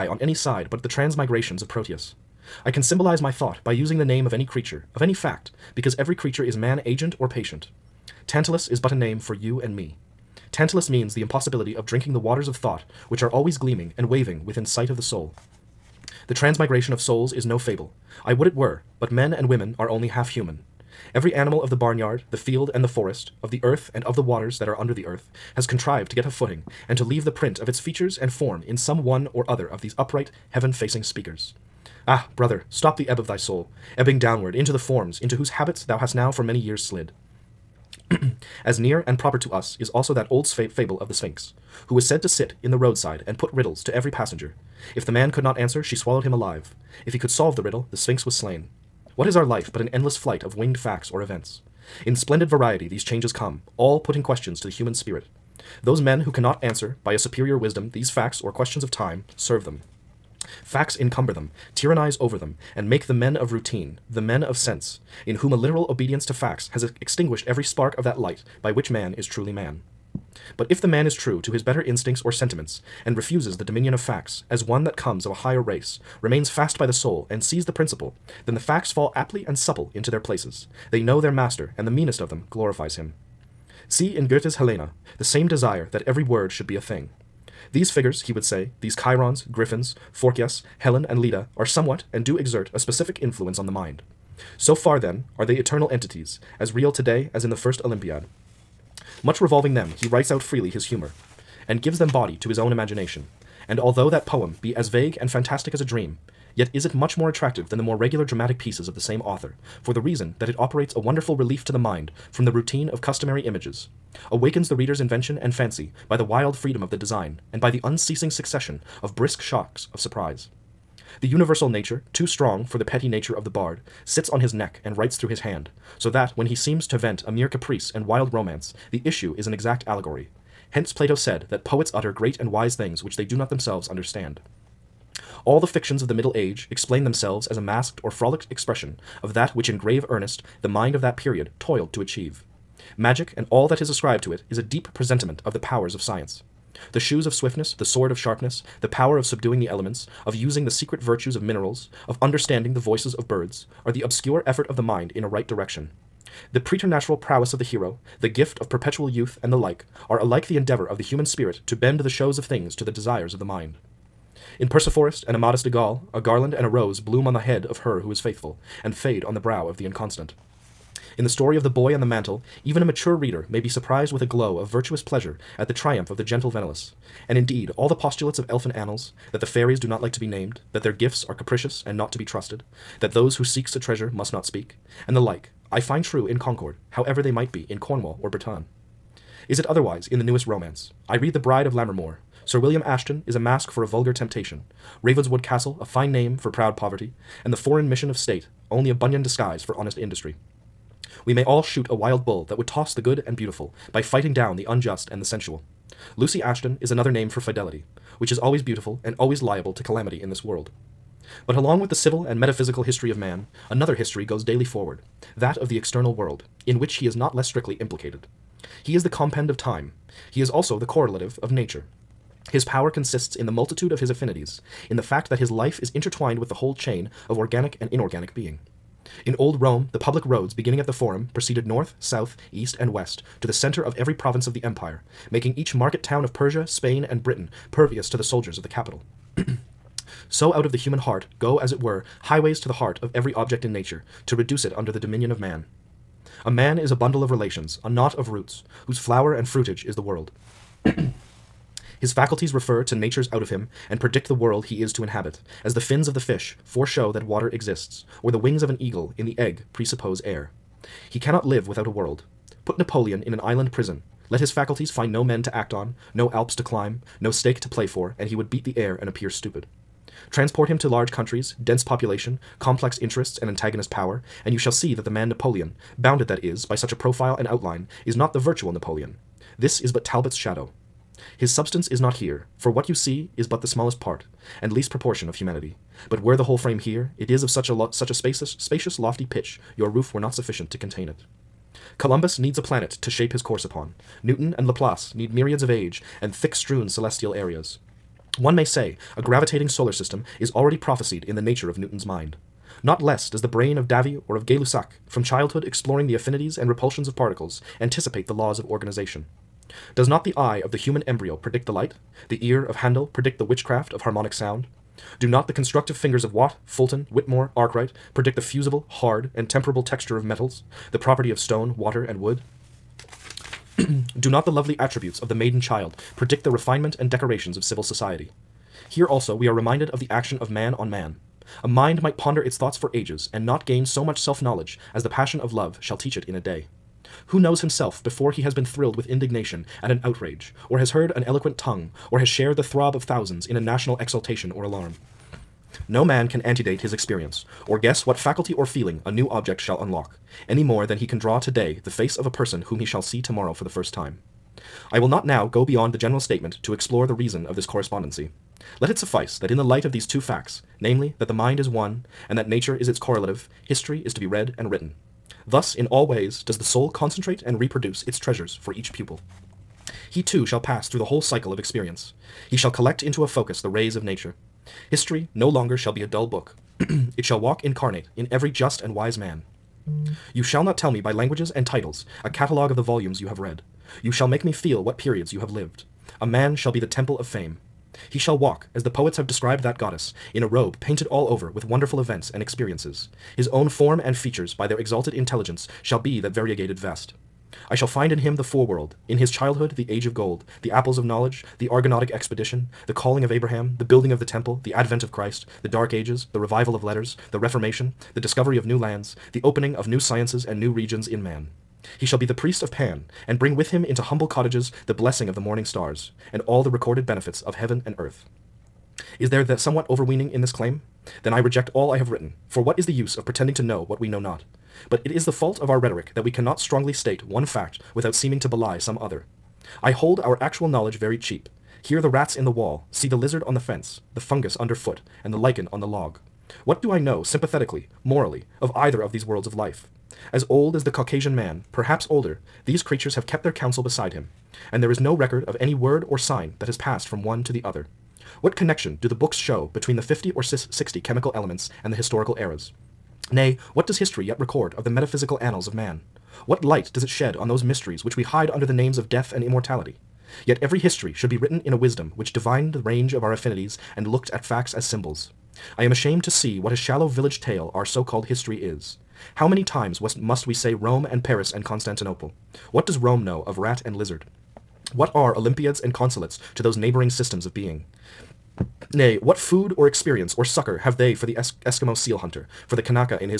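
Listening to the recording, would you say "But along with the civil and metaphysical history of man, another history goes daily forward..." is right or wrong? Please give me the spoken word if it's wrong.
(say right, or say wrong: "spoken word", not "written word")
right.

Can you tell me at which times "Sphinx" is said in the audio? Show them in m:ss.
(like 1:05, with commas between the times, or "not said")
0:41, 0:47.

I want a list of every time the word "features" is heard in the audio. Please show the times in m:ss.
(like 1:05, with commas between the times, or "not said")
0:27, 6:34.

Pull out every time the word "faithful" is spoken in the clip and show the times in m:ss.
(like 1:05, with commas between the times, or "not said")
2:48.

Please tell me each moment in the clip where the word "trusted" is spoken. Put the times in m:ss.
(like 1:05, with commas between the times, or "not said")
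3:02.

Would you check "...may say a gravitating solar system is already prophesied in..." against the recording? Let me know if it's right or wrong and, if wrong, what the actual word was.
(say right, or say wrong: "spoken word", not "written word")
right.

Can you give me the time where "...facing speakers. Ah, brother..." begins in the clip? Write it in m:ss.
0:30.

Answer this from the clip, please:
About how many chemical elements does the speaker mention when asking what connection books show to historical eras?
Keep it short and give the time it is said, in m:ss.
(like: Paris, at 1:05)
50 or 60, at 7:30.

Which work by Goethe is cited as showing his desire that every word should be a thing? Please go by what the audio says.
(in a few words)
Helena.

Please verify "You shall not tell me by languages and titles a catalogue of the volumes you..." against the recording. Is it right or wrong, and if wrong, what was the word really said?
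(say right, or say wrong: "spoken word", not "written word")
right.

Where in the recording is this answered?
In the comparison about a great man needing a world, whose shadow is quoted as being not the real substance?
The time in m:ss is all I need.
4:40.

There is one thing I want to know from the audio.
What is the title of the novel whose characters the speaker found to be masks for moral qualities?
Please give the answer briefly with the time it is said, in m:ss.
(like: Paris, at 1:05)
The Bride of Lammermoor, at 3:11.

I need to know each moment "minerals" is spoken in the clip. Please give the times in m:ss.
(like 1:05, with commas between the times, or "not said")
2:31.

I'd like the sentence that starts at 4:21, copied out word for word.
He cannot live without a world.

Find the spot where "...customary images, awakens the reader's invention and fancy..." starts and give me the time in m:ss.
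1:53.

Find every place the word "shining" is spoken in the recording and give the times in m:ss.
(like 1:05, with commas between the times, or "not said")
not said.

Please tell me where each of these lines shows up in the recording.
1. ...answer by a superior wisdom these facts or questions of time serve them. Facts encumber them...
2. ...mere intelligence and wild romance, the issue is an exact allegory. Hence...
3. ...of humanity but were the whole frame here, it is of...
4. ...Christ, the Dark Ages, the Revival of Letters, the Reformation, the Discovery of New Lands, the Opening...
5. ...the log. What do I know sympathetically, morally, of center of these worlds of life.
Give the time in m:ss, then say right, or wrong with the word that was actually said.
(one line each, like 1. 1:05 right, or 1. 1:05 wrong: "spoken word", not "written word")
1. 0:56 right
2. 2:07 wrong: "caprice", not "intelligence"
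3. 4:45 right
4. 6:45 right
5. 7:15 wrong: "either", not "center".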